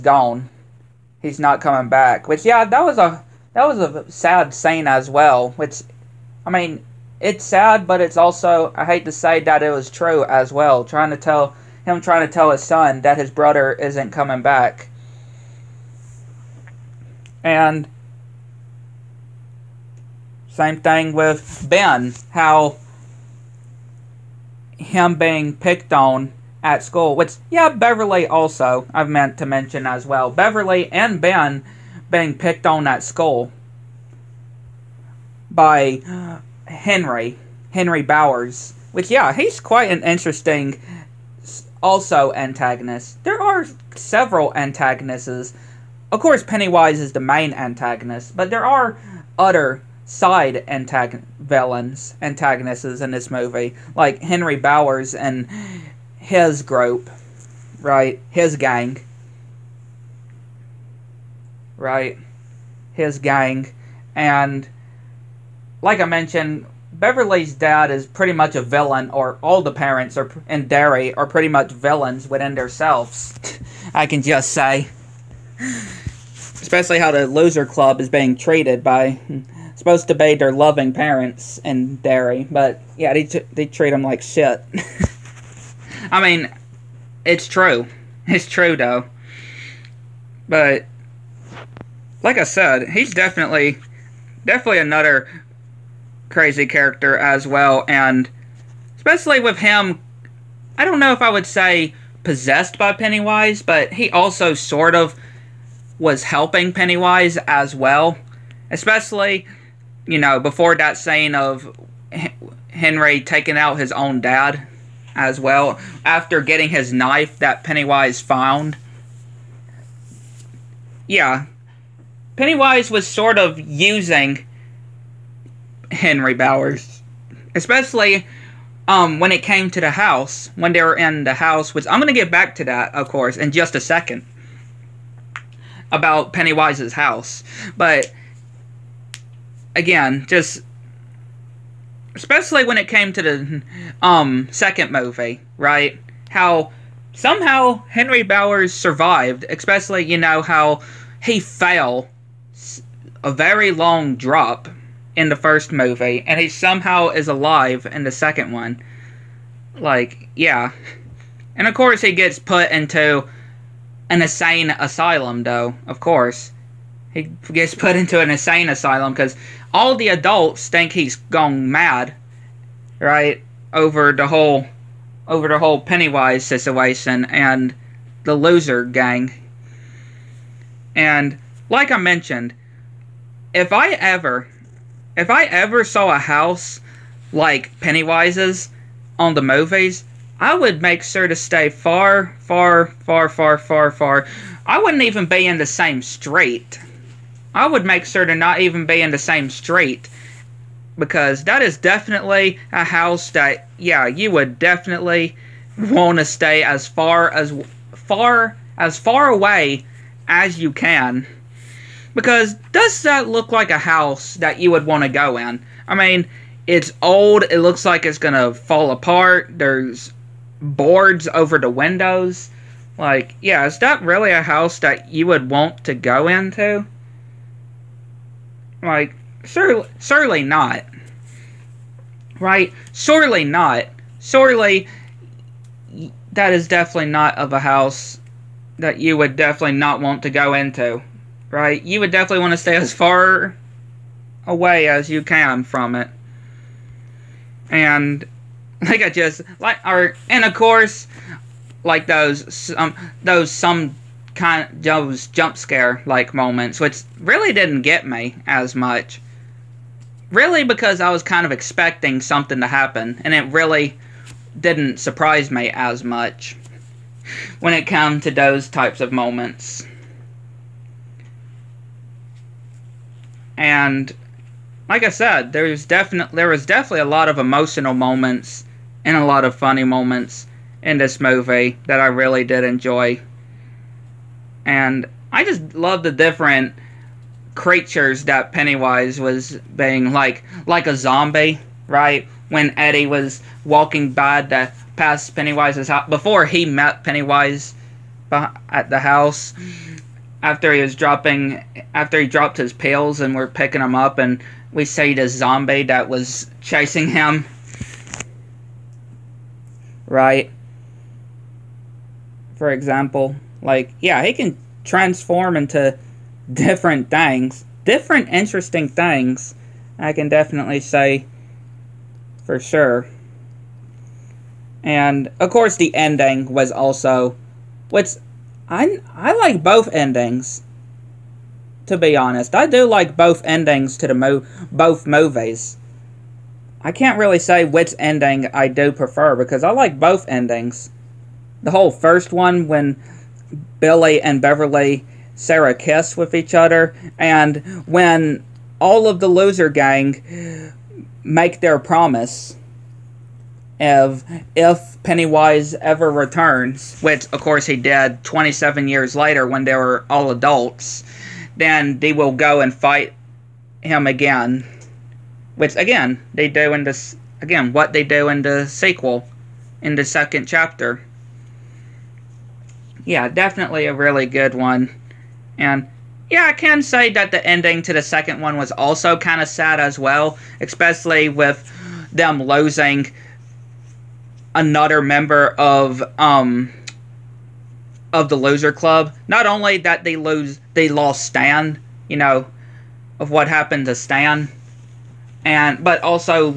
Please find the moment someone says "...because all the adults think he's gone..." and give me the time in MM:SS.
02:49.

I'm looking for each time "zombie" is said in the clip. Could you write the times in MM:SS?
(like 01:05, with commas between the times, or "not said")
04:50, 05:05.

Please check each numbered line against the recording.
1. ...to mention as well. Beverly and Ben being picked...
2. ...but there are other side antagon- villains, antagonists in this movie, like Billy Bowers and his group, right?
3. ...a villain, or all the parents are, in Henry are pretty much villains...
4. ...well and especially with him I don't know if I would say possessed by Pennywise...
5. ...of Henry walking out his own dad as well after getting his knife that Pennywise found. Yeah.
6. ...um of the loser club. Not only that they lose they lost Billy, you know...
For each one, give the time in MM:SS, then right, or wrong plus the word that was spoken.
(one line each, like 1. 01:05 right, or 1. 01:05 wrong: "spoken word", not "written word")
1. 00:29 right
2. 00:48 wrong: "Henry", not "Billy"
3. 01:08 wrong: "Derry", not "Henry"
4. 01:37 right
5. 01:51 wrong: "taking", not "walking"
6. 06:26 wrong: "Stan", not "Billy".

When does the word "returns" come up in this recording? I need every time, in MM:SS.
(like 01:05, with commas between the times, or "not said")
05:56.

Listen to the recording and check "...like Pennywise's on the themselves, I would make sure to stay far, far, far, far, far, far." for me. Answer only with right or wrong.
wrong.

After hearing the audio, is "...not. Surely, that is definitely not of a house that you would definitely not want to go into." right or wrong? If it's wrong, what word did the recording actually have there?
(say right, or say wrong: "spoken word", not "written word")
right.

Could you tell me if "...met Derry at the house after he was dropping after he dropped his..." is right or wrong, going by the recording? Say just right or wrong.
wrong.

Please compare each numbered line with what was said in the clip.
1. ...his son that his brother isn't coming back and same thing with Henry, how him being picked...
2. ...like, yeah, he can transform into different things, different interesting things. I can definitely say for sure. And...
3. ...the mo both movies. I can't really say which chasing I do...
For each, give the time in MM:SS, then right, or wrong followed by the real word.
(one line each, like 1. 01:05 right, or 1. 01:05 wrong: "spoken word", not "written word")
1. 00:12 wrong: "Ben", not "Henry"
2. 05:13 right
3. 05:34 wrong: "ending", not "chasing".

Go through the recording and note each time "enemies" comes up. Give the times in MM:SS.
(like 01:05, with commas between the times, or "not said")
not said.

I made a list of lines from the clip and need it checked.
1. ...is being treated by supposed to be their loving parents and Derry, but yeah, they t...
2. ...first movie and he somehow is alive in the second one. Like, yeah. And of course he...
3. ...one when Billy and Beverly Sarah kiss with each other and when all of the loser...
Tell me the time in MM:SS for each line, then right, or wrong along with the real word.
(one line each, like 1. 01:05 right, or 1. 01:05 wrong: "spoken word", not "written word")
1. 01:18 right
2. 02:35 right
3. 05:42 right.